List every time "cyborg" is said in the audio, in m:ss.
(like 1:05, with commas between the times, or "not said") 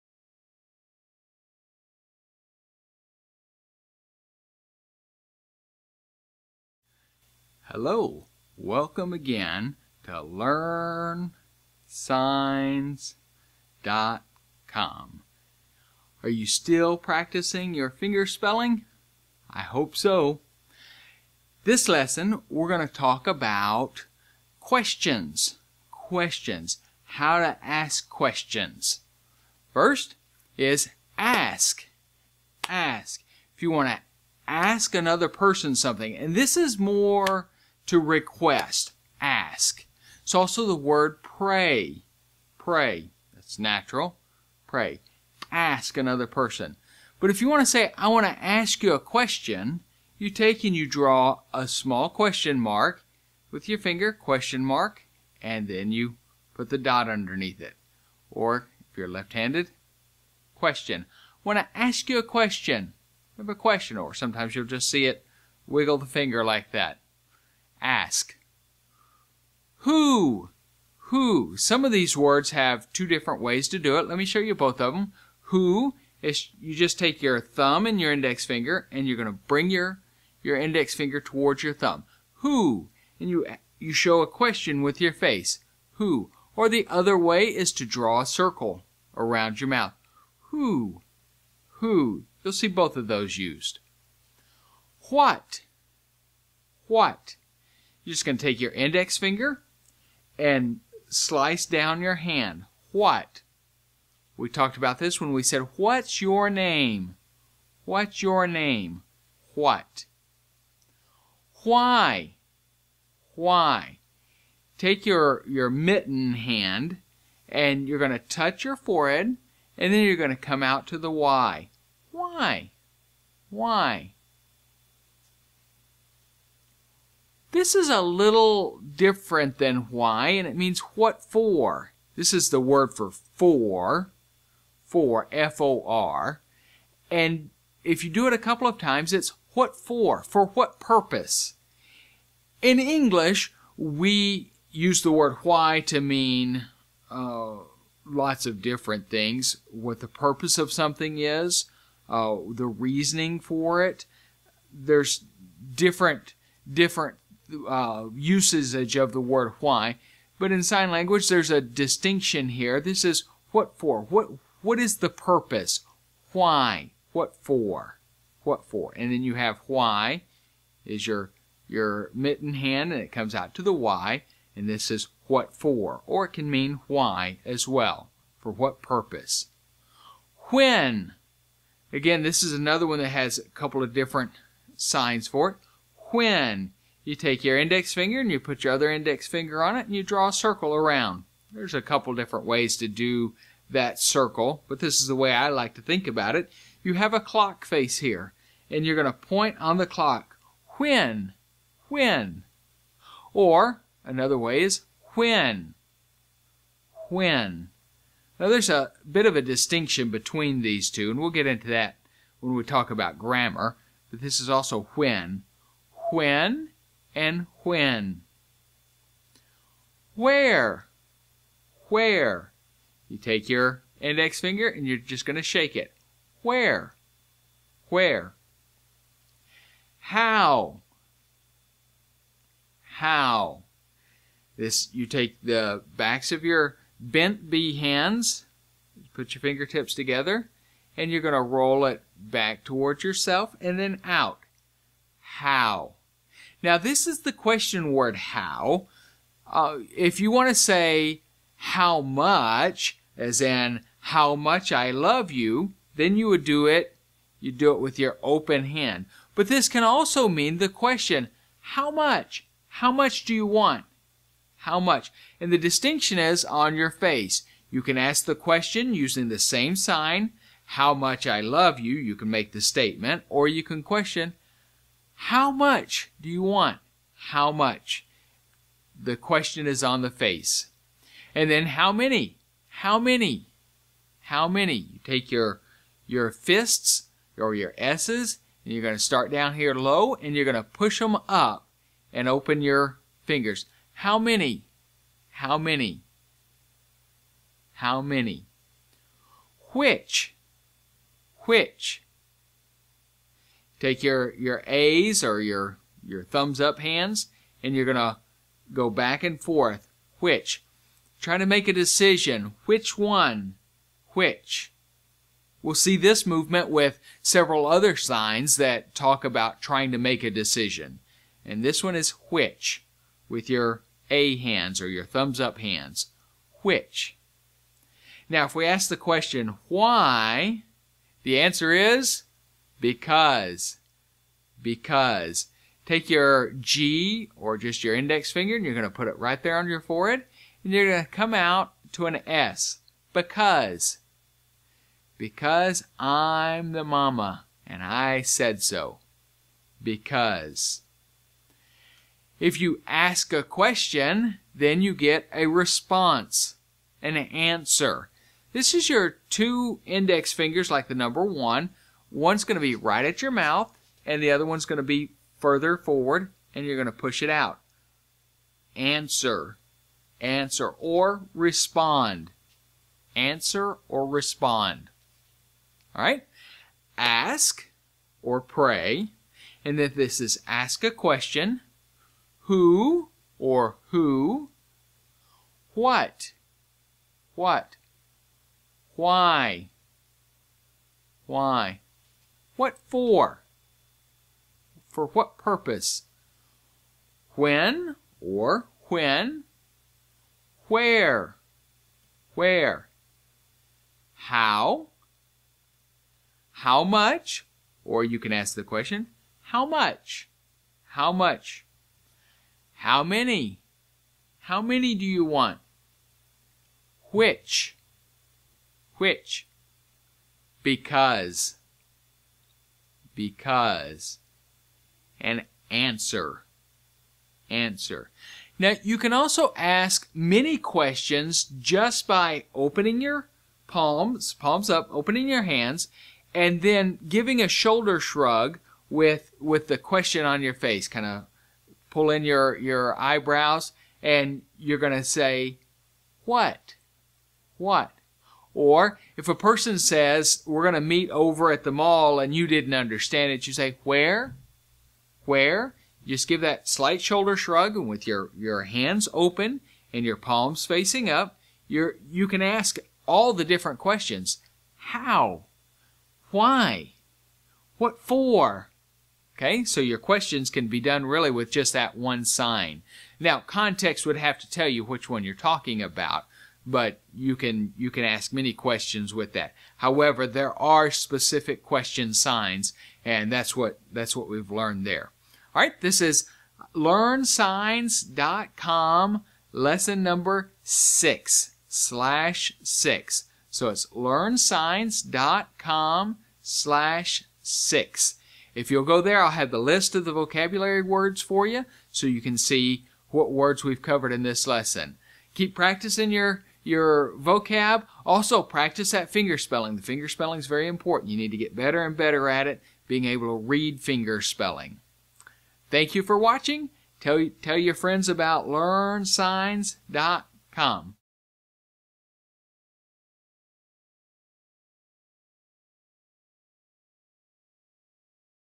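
not said.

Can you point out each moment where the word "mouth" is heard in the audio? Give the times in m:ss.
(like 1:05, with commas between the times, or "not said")
1:29, 6:03.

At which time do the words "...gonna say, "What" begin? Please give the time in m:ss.
7:24.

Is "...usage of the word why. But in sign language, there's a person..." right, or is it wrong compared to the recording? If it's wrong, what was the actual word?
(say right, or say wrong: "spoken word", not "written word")
wrong: "distinction", not "person".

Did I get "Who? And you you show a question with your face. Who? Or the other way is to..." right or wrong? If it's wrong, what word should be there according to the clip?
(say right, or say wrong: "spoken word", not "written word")
right.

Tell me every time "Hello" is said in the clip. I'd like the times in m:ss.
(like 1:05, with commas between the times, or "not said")
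0:07.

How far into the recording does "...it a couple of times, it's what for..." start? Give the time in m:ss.
2:18.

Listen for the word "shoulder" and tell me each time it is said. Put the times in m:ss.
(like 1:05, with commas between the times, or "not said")
7:17, 7:37.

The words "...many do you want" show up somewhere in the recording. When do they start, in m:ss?
6:54.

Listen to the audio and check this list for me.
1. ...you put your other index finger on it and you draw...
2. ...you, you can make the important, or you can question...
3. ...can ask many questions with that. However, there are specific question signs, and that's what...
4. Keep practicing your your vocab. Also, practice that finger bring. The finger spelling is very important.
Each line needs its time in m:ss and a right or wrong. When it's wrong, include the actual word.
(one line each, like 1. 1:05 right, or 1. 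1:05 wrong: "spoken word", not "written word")
1. 3:08 right
2. 4:31 wrong: "statement", not "important"
3. 7:57 right
4. 8:25 wrong: "spelling", not "bring".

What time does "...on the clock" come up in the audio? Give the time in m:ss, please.
3:19.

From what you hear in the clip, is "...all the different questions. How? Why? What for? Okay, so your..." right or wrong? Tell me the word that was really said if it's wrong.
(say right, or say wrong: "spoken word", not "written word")
right.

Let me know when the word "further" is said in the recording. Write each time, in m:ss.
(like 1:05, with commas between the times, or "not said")
6:05.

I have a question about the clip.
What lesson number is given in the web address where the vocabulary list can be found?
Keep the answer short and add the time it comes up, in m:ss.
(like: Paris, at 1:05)
6, at 8:09.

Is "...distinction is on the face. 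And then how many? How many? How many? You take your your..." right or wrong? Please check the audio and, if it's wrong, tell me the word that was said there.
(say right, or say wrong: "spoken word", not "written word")
wrong: "question", not "distinction".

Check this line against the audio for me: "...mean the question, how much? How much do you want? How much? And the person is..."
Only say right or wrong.
wrong.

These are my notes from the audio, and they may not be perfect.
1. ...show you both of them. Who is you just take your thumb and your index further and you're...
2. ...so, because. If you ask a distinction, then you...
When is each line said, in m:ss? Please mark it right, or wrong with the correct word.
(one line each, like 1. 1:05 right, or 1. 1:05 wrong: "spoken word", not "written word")
1. 1:14 wrong: "finger", not "further"
2. 5:48 wrong: "question", not "distinction".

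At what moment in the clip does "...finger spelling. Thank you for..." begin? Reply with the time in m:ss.
8:33.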